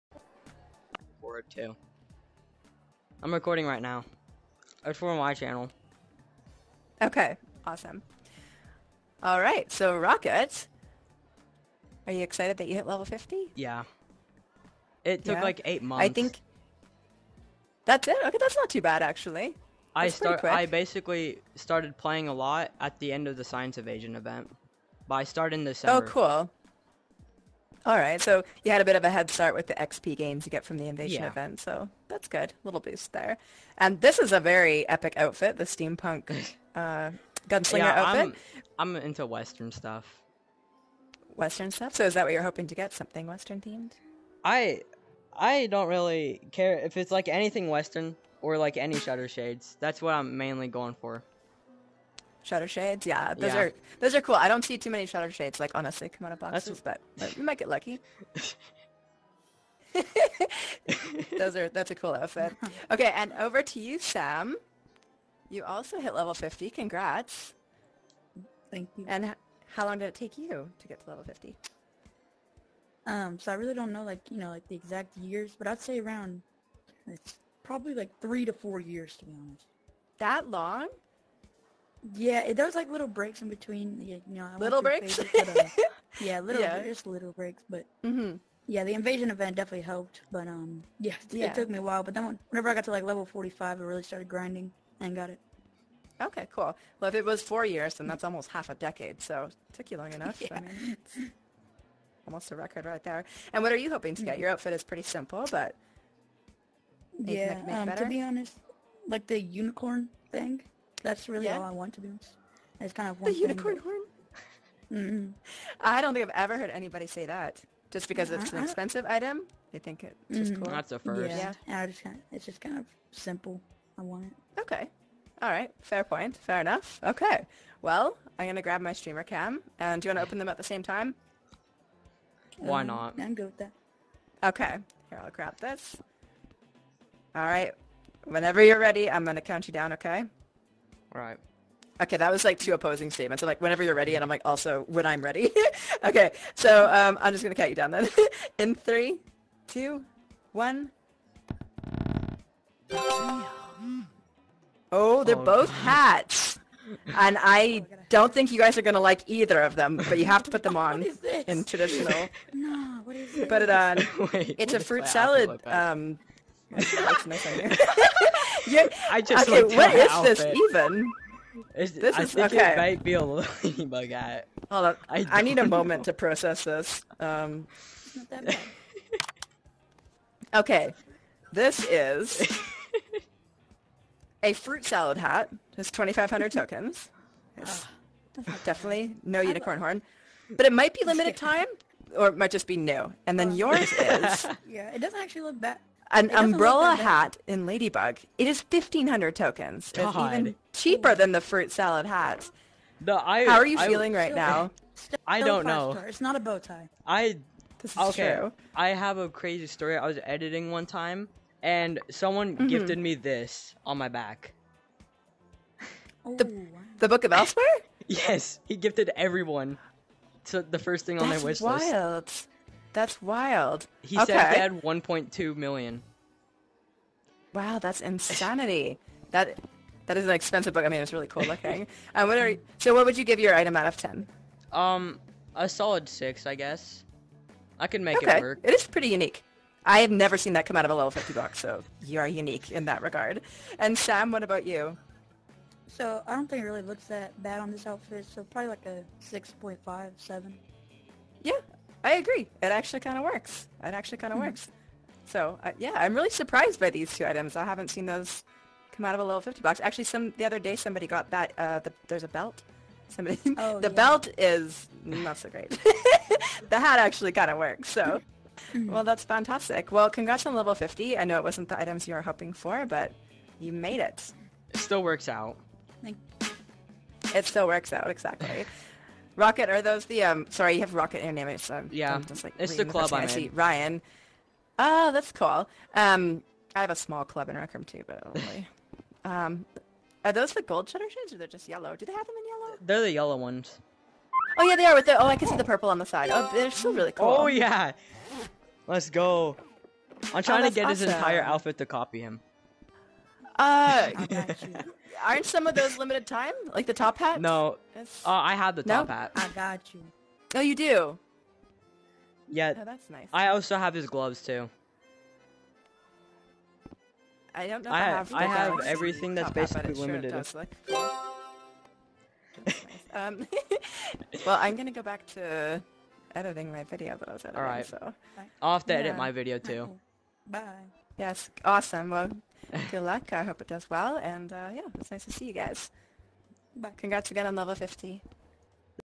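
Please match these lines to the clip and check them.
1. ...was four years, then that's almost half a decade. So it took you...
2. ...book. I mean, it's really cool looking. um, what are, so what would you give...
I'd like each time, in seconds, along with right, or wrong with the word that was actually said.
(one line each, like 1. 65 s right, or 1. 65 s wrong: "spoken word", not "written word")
1. 97 s right
2. 230 s right.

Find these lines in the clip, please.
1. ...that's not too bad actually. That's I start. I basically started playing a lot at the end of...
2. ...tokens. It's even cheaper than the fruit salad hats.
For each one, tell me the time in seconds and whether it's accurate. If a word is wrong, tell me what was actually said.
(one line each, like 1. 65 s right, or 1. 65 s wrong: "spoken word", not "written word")
1. 18 s right
2. 199 s right.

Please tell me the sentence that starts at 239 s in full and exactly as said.
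I have never seen that come out of a level 50 box, so you are unique in that regard.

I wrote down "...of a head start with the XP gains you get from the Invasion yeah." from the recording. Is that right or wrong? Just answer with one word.
right.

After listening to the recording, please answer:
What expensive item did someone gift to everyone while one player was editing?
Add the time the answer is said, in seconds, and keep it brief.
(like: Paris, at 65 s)
Book of Elsewhere, at 217 s.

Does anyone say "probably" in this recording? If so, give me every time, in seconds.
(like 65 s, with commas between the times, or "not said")
77 s, 248 s.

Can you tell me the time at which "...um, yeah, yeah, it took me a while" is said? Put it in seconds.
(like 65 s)
90 s.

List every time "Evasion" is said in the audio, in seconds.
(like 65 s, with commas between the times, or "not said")
23 s.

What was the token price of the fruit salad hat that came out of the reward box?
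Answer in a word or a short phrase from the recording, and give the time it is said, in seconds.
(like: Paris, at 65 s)
2500 tokens, at 185 s.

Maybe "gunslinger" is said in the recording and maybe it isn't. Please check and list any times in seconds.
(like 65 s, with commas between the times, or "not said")
37 s.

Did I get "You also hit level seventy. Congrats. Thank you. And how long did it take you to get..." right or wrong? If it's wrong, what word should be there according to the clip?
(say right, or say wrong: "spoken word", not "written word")
wrong: "fifty", not "seventy".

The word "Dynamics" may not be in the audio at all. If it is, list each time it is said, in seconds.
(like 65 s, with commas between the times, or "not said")
281 s.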